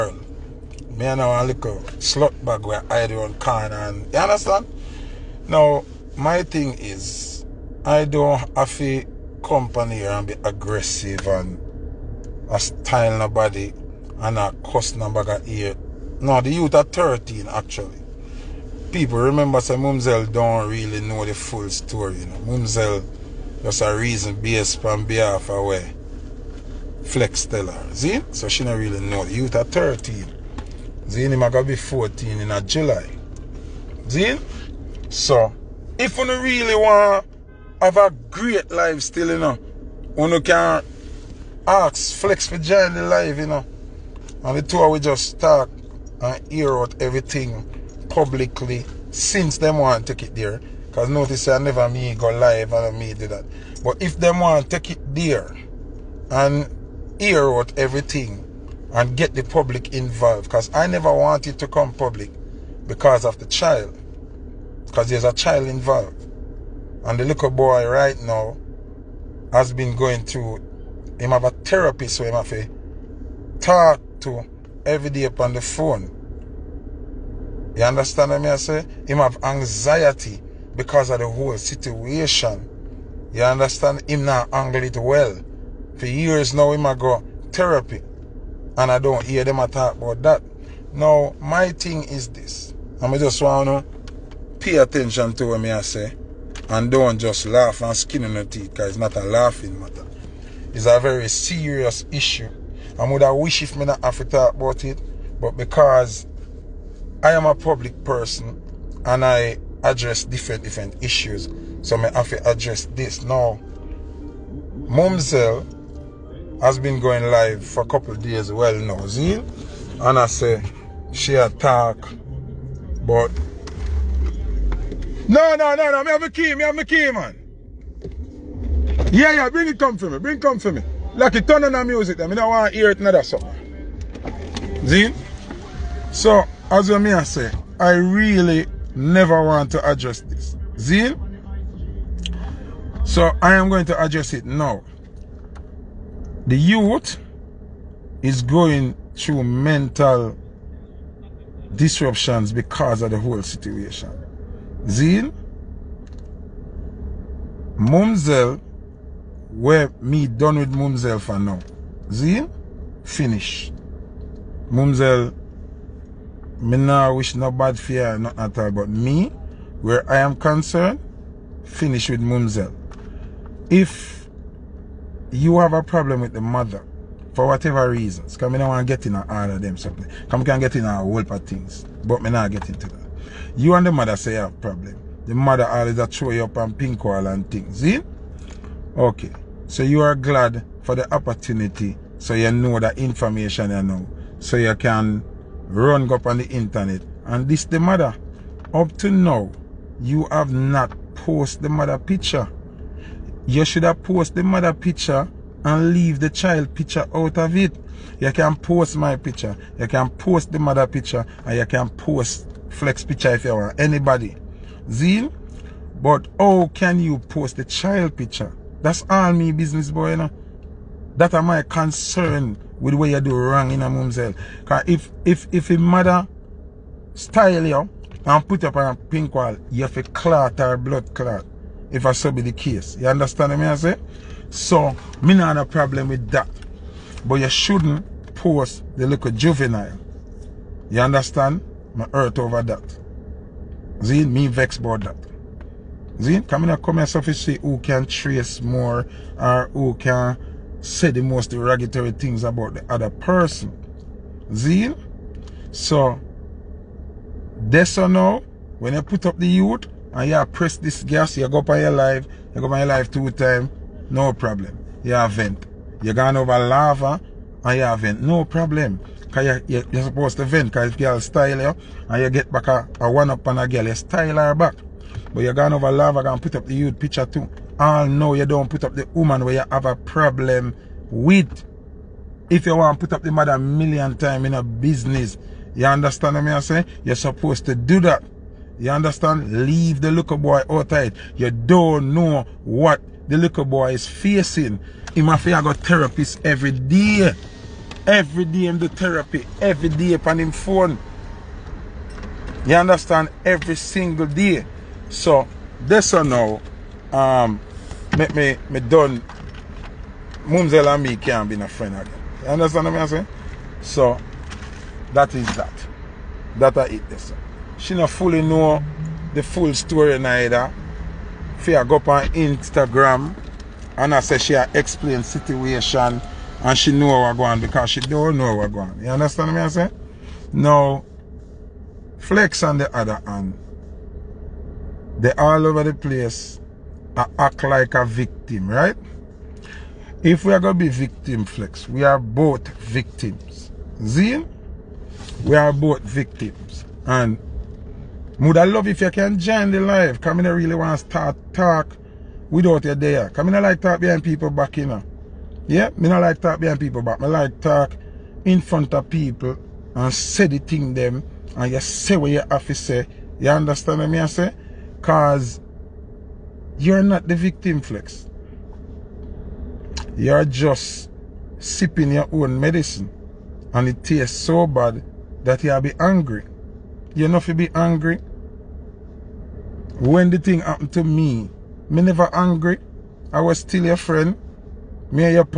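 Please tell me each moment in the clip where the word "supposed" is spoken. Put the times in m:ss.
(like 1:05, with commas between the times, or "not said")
4:30, 4:47.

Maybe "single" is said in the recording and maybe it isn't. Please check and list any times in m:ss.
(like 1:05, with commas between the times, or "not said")
5:03.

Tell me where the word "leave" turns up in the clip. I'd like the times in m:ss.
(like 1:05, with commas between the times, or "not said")
3:25, 4:49.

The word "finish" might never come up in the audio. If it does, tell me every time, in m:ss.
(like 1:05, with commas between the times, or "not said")
2:43, 2:51.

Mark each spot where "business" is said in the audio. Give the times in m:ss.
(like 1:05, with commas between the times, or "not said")
3:39, 4:44.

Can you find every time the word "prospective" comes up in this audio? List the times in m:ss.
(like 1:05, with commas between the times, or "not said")
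not said.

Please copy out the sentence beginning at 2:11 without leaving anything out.
Like it turn on the music, I mean, I want to hear it another song.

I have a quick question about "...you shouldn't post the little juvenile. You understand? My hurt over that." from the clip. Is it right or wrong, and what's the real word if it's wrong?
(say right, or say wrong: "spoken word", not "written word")
right.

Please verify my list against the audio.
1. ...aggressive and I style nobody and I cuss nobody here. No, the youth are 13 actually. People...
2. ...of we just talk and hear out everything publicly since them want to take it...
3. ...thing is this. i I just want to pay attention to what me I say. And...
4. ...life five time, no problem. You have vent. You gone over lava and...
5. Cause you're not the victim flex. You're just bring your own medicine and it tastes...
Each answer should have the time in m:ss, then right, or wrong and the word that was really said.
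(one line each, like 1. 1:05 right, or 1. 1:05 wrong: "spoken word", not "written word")
1. 0:10 right
2. 0:44 right
3. 1:31 right
4. 4:22 wrong: "two", not "five"
5. 6:05 wrong: "sipping", not "bring".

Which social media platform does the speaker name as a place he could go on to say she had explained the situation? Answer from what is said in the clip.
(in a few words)
Instagram.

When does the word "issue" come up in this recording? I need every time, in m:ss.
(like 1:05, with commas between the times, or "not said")
1:42, 1:51.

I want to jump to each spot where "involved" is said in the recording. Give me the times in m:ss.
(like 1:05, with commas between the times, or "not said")
0:59, 1:05.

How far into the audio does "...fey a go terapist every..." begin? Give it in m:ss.
4:55.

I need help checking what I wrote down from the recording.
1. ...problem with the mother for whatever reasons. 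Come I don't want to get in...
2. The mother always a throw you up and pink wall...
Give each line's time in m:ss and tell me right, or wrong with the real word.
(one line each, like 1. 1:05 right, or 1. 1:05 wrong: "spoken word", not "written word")
1. 2:55 right
2. 3:05 right.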